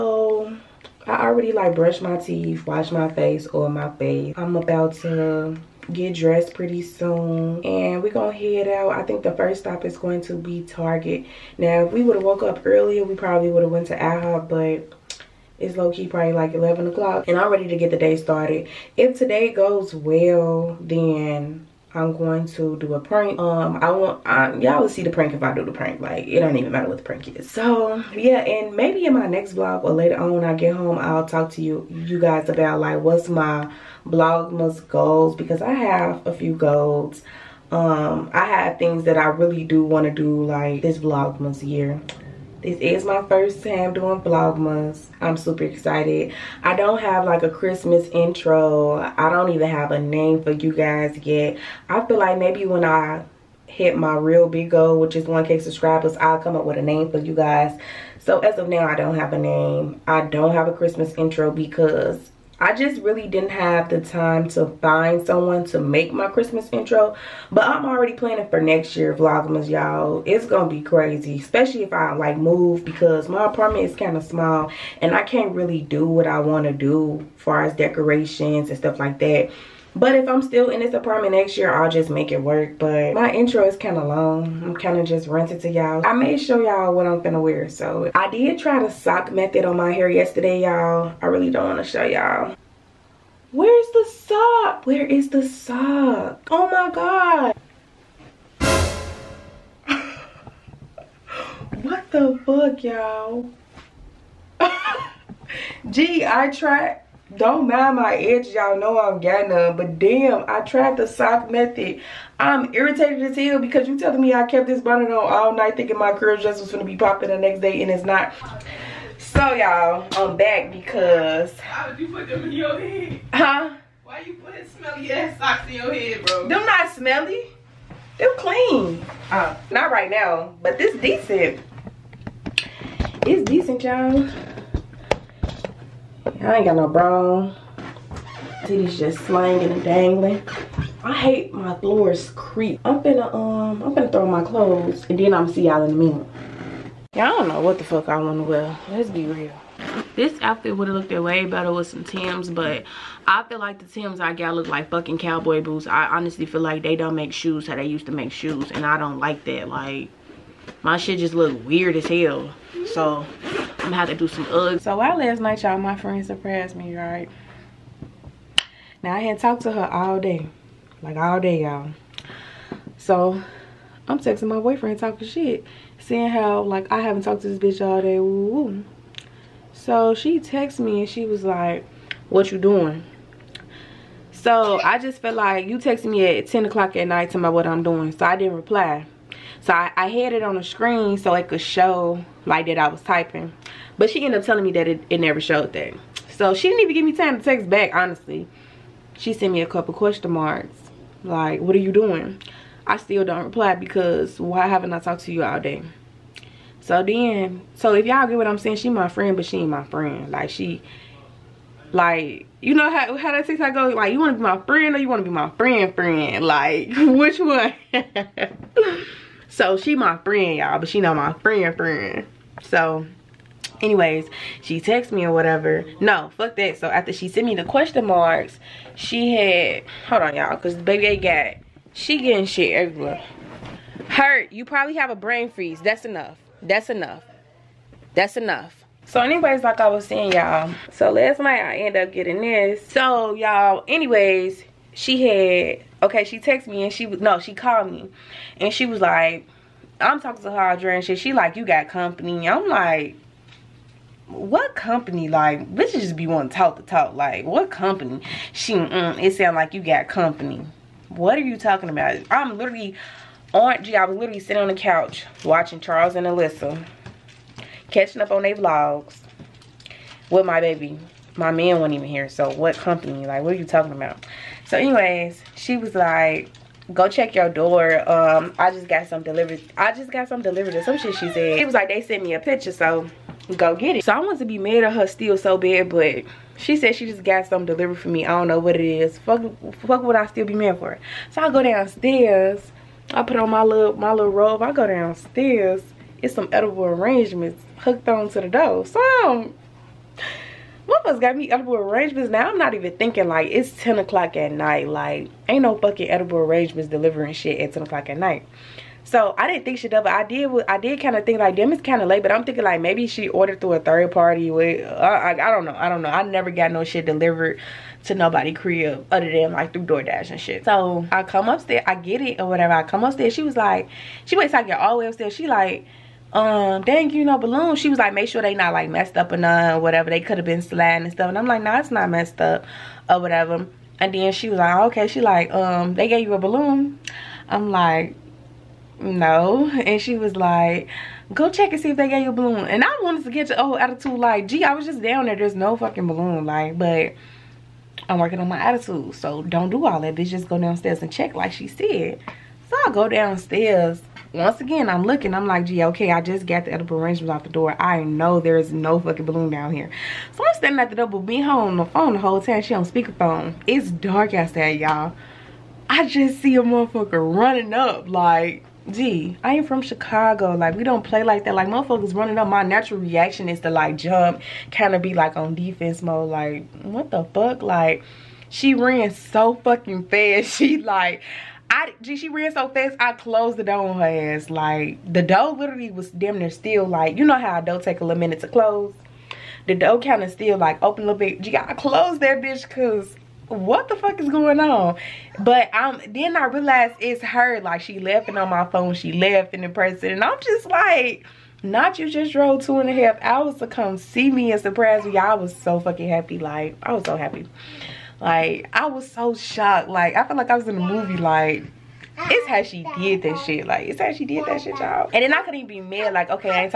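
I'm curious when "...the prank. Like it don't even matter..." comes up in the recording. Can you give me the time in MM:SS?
00:25.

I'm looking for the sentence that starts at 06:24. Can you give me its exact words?
Like the door literally was damn near still like you know how a door take a little minute to close.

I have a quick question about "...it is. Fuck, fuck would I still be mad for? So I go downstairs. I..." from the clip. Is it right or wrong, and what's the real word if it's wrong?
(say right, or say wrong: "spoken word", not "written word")
right.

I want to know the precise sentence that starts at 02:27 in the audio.
Y'all don't know what the fuck I wanna wear.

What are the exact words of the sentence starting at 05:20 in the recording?
So I come upstairs, I get it or whatever.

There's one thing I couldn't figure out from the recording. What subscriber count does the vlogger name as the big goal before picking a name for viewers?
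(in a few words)
1K.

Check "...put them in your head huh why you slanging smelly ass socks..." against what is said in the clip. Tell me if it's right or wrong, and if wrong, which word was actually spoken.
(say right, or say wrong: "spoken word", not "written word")
wrong: "putting", not "slanging".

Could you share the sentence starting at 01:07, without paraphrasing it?
But I'm already planning for next year Vlogmas, y'all.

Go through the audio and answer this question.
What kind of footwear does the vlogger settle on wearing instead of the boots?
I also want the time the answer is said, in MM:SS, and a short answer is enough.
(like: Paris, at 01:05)
Uggs, at 02:44.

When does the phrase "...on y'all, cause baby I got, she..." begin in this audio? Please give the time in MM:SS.
03:50.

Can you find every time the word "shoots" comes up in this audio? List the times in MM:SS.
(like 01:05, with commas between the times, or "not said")
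not said.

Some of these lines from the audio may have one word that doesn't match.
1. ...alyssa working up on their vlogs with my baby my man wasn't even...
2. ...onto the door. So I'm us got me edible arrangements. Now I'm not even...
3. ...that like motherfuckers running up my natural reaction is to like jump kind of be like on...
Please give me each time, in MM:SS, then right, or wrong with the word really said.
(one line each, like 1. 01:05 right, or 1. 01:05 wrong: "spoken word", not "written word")
1. 04:26 wrong: "catching", not "working"
2. 04:58 right
3. 06:11 right.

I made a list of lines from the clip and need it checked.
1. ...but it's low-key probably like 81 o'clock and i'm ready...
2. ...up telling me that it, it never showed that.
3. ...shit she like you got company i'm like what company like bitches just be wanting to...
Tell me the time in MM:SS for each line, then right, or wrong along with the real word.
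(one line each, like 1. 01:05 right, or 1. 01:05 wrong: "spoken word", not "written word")
1. 00:14 wrong: "11", not "81"
2. 03:14 right
3. 04:11 right.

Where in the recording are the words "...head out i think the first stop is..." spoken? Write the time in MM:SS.
00:08.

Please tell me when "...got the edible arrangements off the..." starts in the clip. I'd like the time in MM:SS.
05:56.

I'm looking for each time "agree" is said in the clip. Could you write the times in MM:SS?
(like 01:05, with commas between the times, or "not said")
not said.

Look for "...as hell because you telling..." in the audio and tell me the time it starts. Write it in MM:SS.
01:53.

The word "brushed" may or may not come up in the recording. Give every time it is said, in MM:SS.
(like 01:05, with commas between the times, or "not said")
00:01.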